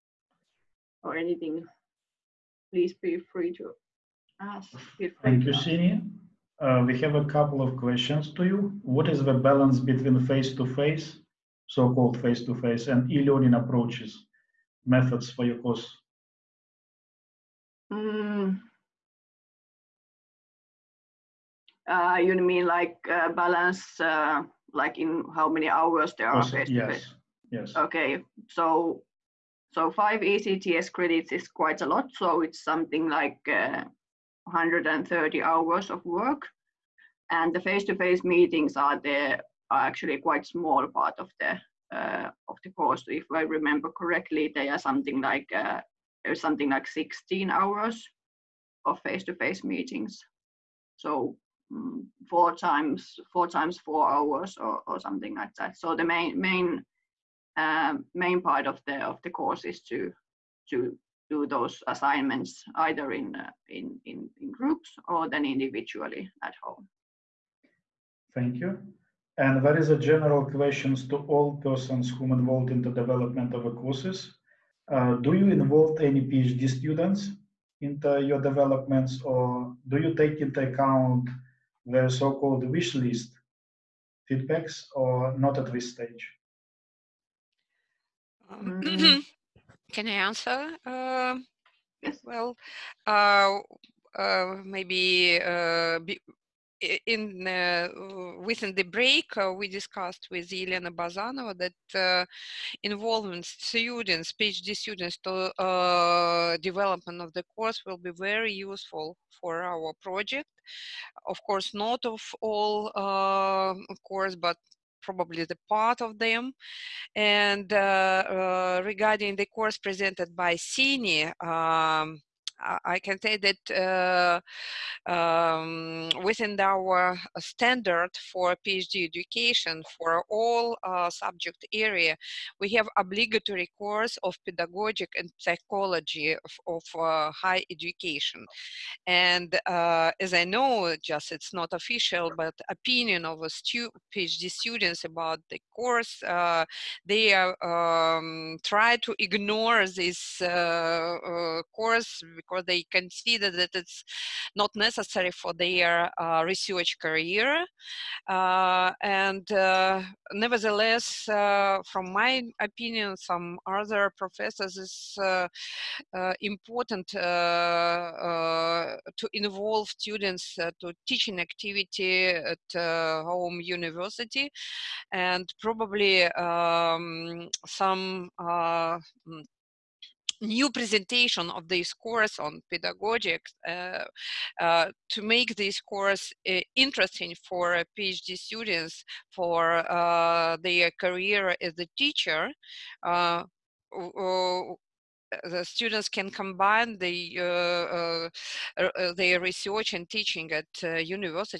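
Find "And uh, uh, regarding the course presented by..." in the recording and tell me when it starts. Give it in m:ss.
1:57.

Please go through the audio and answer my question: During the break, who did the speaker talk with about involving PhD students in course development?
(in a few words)
Elena Bazanova.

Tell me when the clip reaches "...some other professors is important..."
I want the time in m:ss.
2:43.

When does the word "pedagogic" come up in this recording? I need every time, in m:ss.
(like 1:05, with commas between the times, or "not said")
2:14, 3:02.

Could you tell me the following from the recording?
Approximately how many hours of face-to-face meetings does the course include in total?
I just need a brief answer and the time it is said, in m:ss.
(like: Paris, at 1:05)
16, at 0:46.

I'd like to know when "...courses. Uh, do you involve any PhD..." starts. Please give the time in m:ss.
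1:13.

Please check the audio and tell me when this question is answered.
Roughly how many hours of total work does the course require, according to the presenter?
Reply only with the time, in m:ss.
0:33.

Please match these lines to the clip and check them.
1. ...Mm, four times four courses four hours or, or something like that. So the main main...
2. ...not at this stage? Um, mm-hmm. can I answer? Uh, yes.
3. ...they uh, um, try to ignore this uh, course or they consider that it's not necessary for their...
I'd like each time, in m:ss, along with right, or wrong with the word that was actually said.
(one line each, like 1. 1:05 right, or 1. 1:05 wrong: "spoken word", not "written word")
1. 0:51 wrong: "times", not "courses"
2. 1:25 right
3. 2:27 right.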